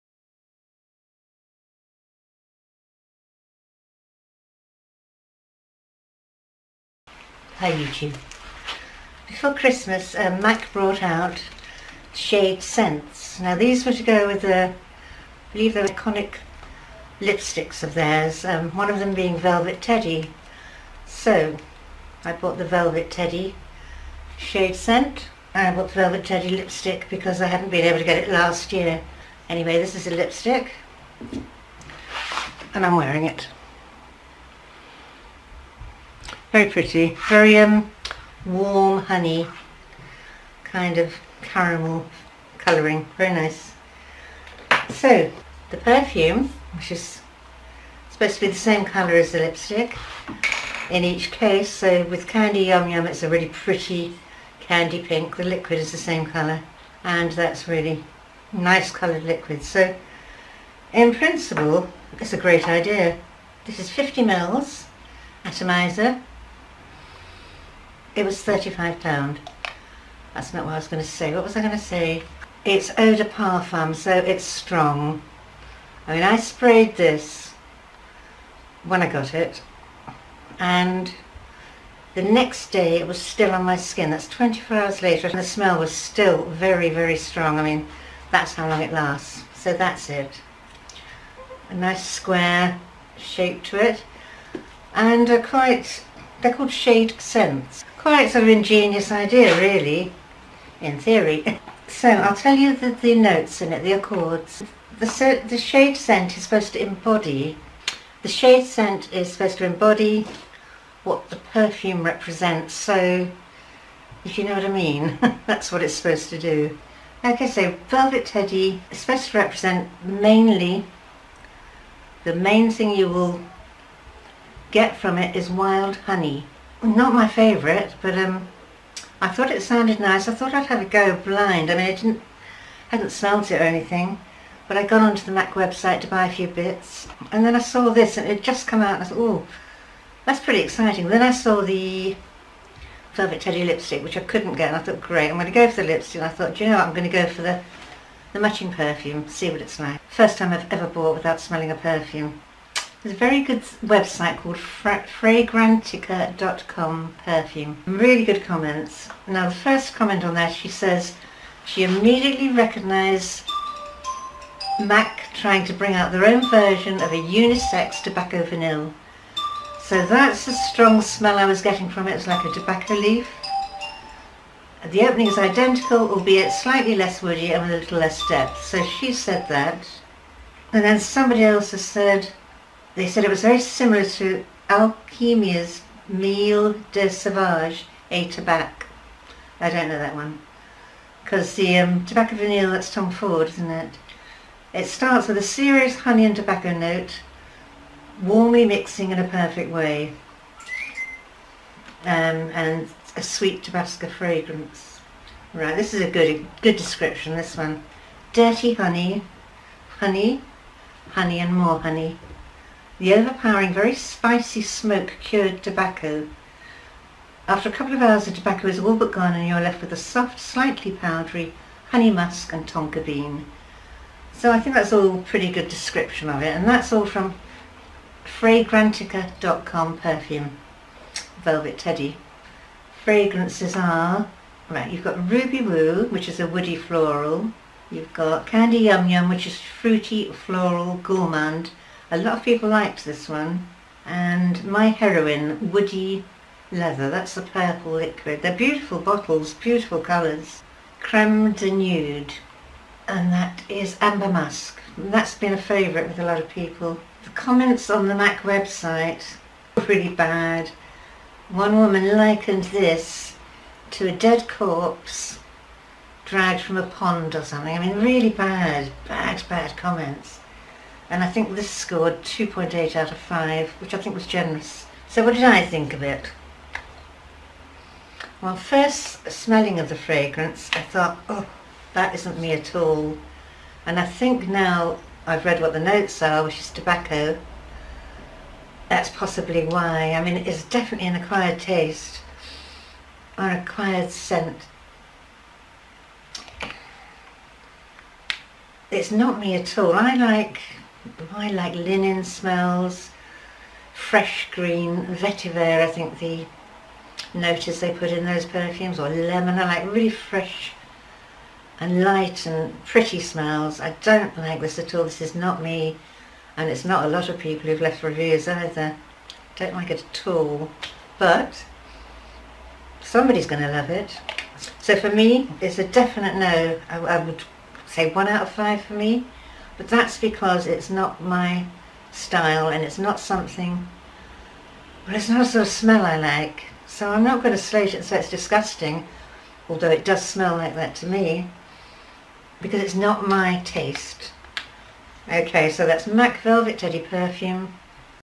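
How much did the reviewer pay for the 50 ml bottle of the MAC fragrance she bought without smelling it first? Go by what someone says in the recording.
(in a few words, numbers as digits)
£35.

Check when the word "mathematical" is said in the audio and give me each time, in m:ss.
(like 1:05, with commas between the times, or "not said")
not said.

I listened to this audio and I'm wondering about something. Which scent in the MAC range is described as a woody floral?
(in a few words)
Ruby Woo.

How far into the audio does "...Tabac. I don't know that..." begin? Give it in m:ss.
3:08.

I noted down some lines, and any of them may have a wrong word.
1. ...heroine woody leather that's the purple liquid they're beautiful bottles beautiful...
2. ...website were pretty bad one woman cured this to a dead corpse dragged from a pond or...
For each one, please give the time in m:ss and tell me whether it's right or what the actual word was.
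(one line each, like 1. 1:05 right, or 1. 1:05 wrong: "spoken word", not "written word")
1. 4:04 right
2. 4:18 wrong: "likened", not "cured".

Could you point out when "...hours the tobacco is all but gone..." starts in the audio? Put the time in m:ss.
3:38.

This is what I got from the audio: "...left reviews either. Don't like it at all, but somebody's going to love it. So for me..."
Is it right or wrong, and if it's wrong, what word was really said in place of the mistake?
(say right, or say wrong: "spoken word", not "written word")
right.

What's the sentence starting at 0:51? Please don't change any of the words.
So with Candy Yum Yum it's a really pretty candy pink.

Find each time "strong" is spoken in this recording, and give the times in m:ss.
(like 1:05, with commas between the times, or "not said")
1:14, 1:27, 2:50.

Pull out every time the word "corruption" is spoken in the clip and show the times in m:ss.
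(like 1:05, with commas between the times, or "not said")
not said.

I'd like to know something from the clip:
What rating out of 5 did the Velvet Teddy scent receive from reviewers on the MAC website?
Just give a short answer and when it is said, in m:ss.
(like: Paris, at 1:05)
2.8, at 4:32.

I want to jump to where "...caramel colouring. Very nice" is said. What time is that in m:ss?
0:41.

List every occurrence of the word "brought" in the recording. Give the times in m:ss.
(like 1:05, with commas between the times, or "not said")
0:10.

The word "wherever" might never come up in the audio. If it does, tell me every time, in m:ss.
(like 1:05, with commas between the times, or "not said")
not said.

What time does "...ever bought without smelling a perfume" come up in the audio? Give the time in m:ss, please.
2:30.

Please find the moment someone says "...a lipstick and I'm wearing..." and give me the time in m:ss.
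0:30.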